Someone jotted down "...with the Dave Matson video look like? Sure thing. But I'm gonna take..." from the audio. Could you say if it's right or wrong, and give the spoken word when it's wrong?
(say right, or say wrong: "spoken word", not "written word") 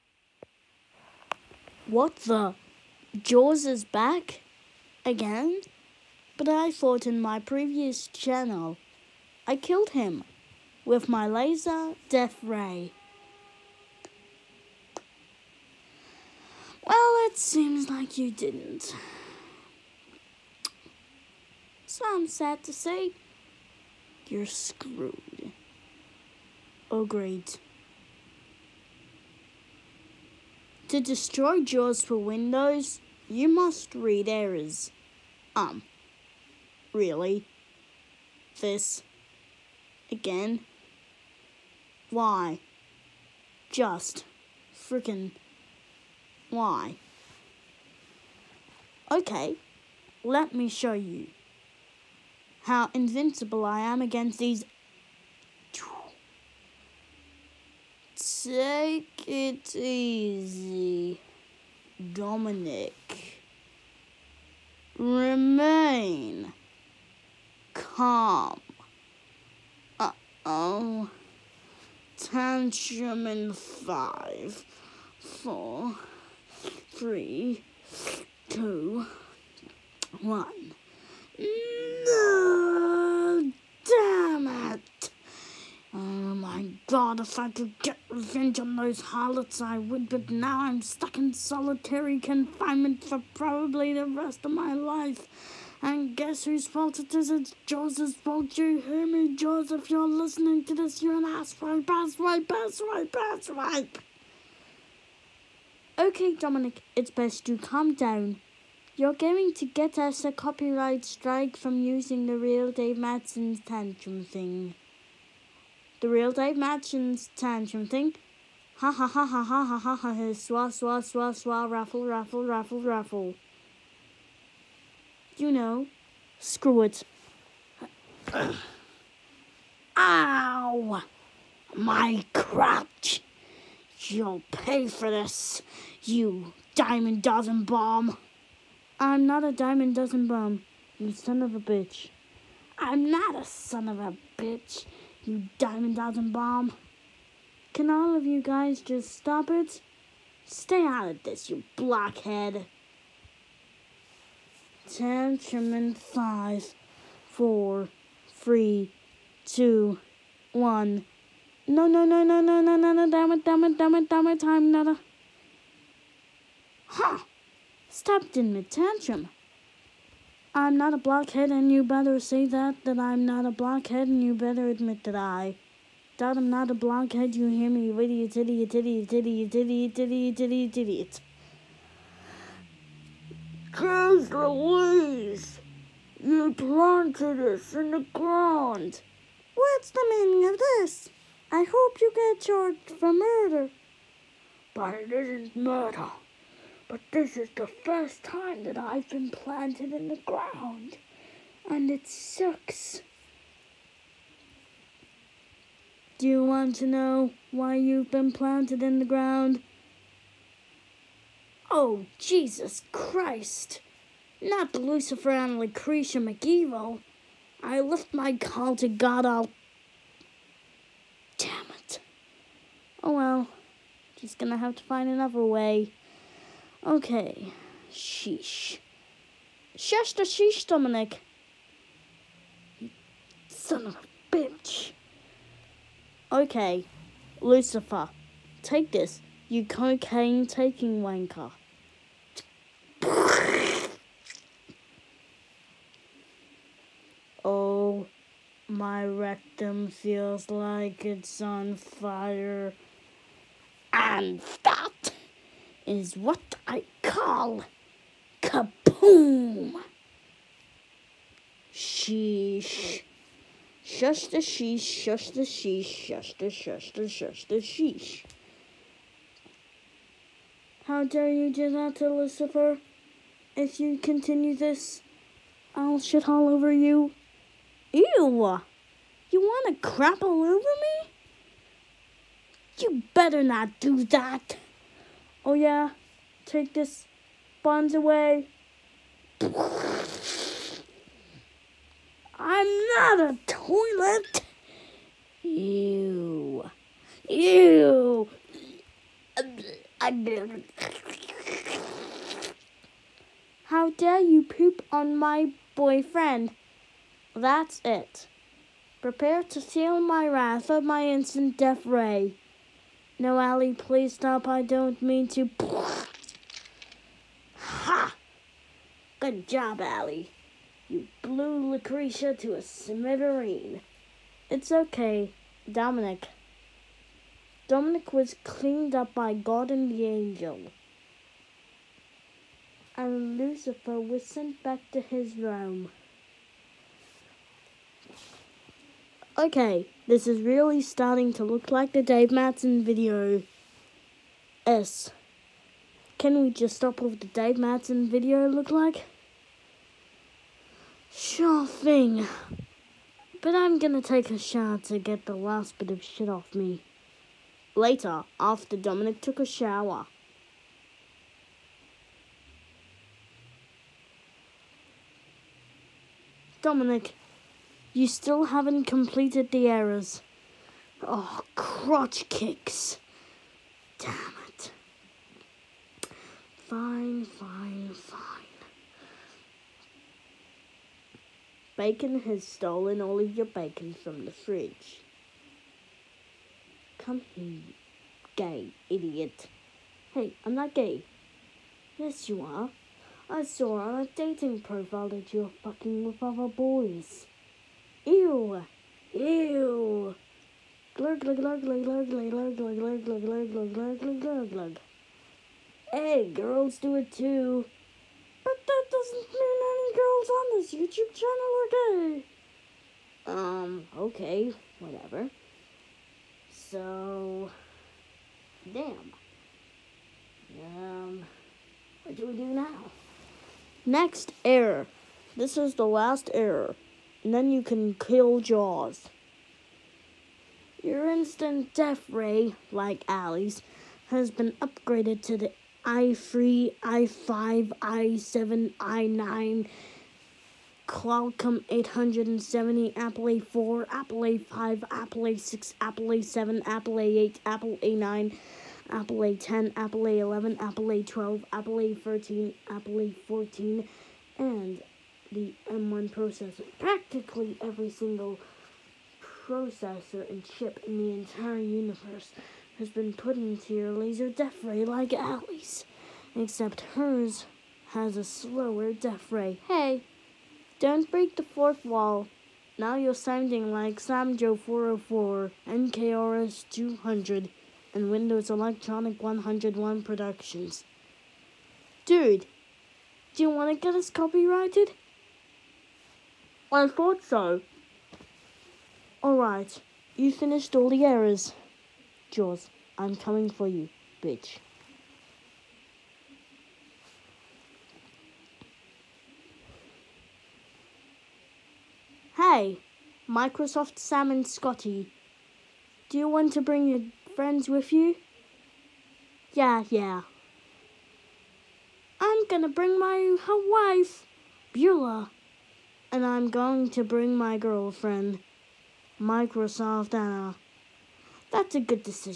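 right.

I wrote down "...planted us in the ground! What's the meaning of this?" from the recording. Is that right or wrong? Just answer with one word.
right.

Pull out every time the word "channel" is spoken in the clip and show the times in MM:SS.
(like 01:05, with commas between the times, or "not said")
00:08, 06:51.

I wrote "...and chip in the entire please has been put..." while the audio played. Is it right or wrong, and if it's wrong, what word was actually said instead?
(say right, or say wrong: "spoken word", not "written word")
wrong: "universe", not "please".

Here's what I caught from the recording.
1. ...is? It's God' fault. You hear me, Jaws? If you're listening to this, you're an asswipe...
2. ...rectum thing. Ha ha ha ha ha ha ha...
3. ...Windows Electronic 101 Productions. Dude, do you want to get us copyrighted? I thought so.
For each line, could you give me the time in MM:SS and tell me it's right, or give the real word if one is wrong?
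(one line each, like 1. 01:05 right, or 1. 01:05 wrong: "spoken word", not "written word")
1. 01:37 wrong: "Jaws", not "God"
2. 01:57 wrong: "tantrum", not "rectum"
3. 07:58 right.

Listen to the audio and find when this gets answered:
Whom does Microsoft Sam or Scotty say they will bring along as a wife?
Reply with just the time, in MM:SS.
08:34.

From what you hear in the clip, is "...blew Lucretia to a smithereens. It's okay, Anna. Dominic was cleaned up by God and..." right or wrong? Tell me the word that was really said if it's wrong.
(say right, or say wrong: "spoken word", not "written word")
wrong: "Dominic", not "Anna".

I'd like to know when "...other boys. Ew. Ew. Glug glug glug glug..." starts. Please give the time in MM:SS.
06:36.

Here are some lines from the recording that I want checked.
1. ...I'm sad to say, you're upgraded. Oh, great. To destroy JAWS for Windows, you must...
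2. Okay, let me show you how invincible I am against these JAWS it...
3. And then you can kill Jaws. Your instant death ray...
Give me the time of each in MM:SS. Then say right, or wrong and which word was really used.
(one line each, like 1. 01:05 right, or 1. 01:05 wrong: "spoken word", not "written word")
1. 00:22 wrong: "screwed", not "upgraded"
2. 00:49 wrong: "Take", not "JAWS"
3. 07:07 right.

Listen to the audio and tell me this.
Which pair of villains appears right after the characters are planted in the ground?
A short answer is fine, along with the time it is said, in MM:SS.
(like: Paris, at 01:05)
Lucifer and Lucretia McEvil, at 03:34.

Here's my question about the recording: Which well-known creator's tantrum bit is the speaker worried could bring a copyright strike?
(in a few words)
Dave Madsen.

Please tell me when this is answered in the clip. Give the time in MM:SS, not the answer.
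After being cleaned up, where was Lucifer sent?
05:34.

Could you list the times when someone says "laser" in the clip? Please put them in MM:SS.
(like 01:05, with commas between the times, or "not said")
00:11, 07:43.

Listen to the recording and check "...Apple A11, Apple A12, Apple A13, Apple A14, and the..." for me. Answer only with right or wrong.
right.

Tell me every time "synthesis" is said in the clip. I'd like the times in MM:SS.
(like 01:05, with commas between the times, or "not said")
not said.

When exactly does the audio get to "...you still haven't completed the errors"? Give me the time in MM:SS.
06:07.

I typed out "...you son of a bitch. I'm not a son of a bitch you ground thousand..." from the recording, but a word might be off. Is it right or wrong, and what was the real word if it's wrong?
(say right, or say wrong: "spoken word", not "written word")
wrong: "diamond", not "ground".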